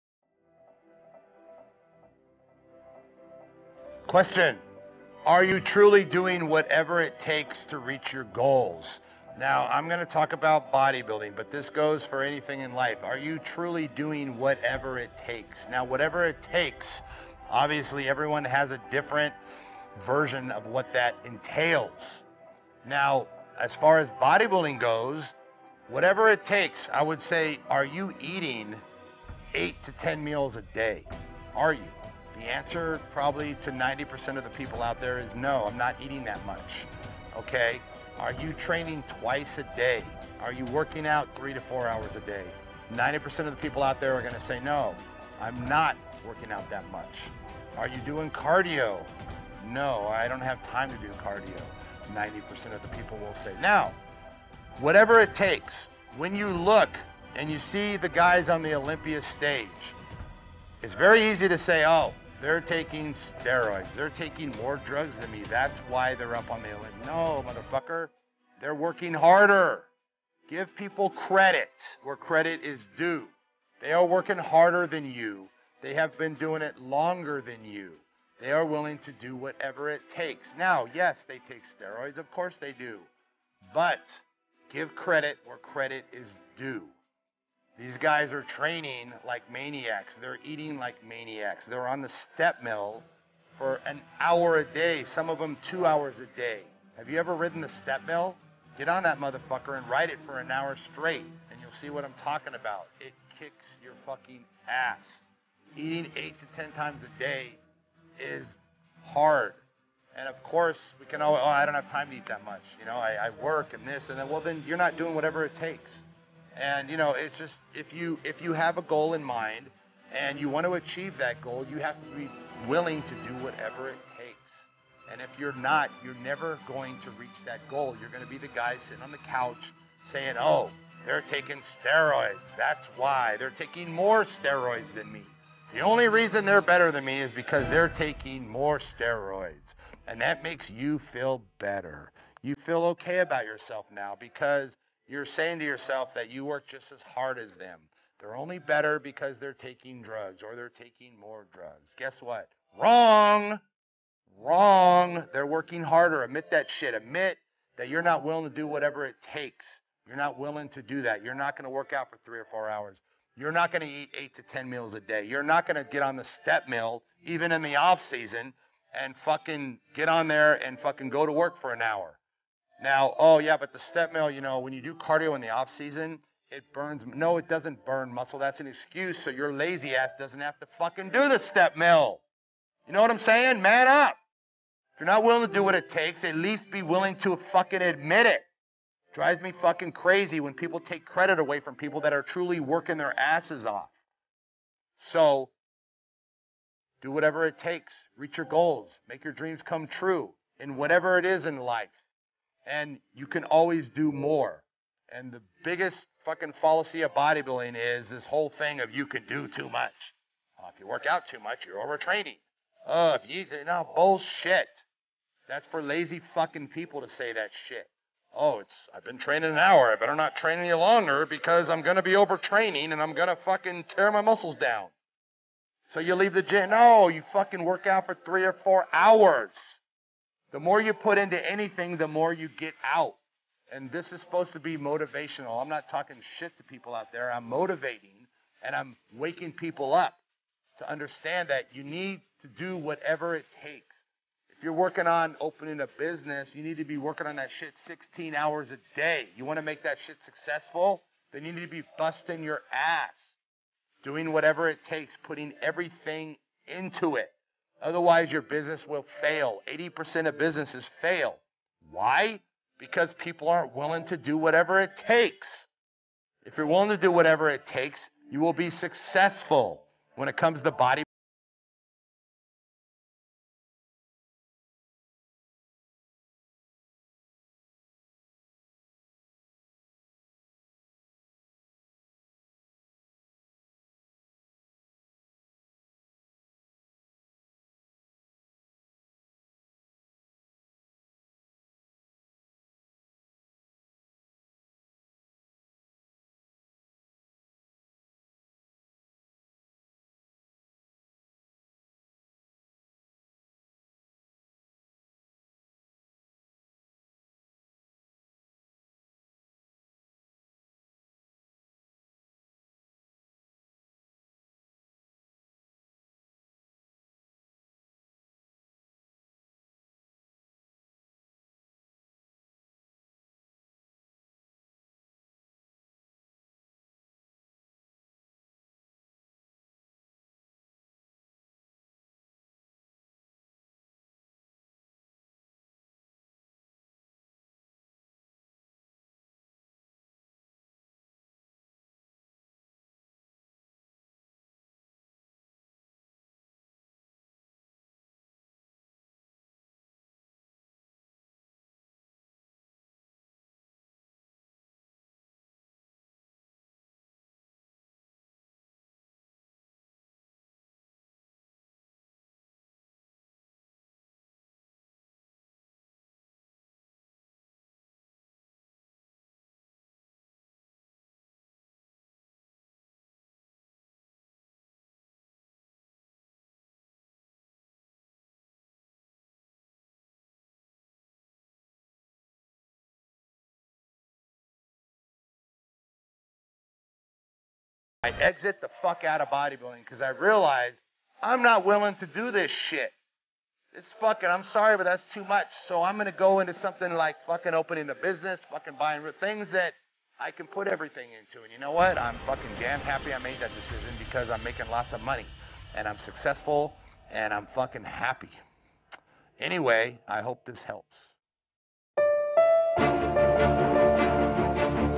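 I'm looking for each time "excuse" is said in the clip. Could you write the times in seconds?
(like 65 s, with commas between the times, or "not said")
178 s.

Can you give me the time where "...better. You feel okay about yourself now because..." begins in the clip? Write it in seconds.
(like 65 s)
141 s.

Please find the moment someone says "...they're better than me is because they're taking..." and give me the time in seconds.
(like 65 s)
136 s.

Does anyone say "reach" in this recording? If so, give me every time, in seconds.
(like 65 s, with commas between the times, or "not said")
7 s, 127 s, 198 s.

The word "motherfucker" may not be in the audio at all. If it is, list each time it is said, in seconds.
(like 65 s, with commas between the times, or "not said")
67 s, 99 s.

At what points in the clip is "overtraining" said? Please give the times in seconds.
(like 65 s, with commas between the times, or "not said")
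211 s, 222 s.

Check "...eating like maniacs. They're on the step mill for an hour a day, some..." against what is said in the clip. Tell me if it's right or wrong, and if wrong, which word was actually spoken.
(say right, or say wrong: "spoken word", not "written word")
right.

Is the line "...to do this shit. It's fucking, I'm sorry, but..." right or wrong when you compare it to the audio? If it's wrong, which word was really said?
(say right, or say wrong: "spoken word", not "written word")
right.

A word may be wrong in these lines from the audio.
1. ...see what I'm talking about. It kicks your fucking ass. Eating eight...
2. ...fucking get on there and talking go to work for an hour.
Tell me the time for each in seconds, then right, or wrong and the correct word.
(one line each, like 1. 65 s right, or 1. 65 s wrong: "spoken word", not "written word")
1. 101 s right
2. 169 s wrong: "fucking", not "talking".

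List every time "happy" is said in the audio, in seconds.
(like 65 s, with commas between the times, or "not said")
402 s, 407 s.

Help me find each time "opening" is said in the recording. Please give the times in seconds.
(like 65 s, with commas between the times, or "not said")
245 s, 397 s.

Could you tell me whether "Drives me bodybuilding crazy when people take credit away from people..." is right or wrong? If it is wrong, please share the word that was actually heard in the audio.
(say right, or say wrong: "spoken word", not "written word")
wrong: "fucking", not "bodybuilding".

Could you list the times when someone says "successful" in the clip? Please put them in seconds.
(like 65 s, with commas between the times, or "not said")
250 s, 268 s, 405 s.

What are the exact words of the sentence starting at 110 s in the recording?
And of course, we can always, oh, I don't have time to eat that much.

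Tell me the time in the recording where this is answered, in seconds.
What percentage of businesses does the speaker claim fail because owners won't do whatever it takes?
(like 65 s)
259 s.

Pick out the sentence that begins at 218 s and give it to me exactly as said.
Oh, it's I've been training an hour.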